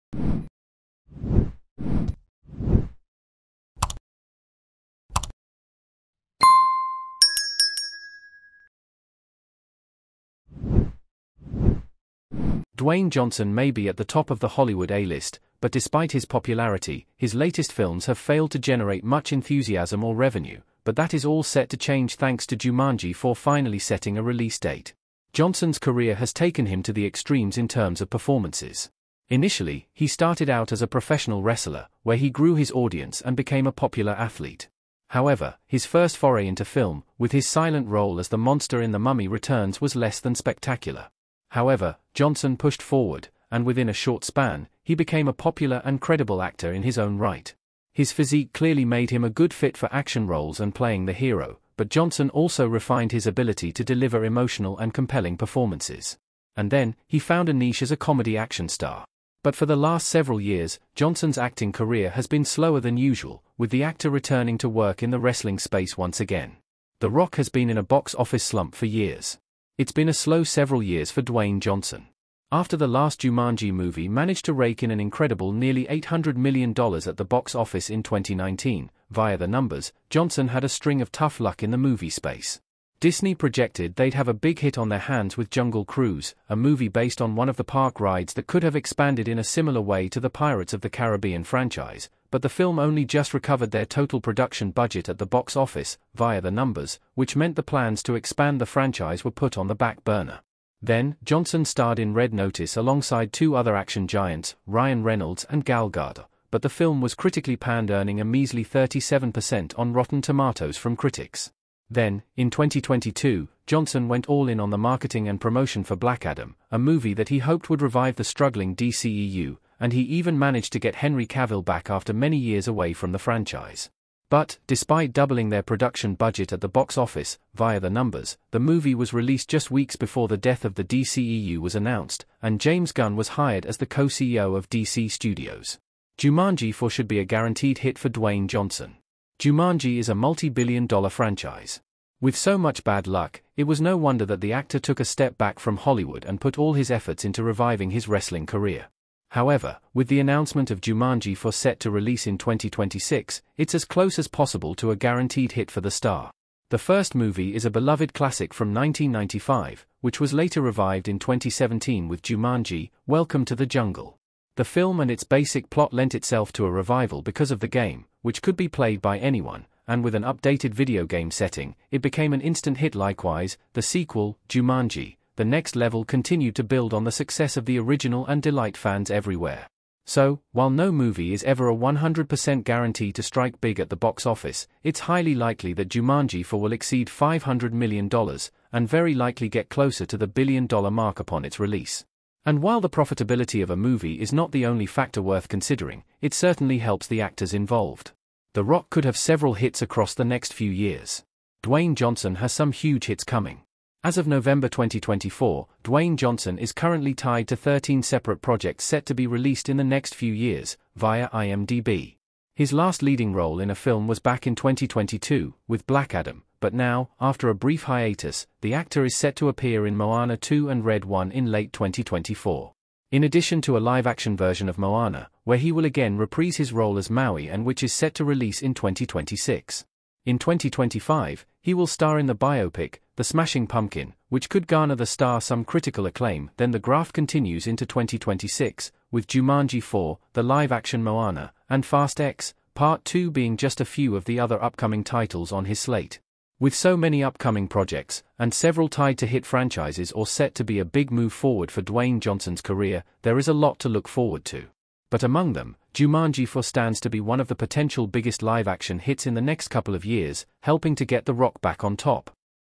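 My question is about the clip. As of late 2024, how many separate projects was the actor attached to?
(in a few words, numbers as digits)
13.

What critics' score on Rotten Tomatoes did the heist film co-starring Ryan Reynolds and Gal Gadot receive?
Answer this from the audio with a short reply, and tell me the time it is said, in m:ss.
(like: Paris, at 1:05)
37%, at 1:48.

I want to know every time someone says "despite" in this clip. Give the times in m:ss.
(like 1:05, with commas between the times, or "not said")
0:15, 2:04.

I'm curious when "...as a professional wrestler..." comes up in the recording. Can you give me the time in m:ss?
0:30.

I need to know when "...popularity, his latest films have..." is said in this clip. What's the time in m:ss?
0:16.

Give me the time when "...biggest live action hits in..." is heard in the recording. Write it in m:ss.
4:18.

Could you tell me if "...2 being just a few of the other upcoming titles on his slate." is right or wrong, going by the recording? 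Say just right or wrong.
right.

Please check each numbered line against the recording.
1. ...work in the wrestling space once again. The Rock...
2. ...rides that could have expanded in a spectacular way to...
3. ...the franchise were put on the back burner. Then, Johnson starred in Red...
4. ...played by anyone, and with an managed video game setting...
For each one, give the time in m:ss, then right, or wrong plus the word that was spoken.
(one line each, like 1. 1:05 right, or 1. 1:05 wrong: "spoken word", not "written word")
1. 1:04 right
2. 1:27 wrong: "similar", not "spectacular"
3. 1:38 right
4. 2:48 wrong: "updated", not "managed".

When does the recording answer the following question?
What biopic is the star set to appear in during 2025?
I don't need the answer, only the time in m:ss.
3:53.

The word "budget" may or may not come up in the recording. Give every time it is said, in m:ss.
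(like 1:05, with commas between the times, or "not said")
1:34, 2:06.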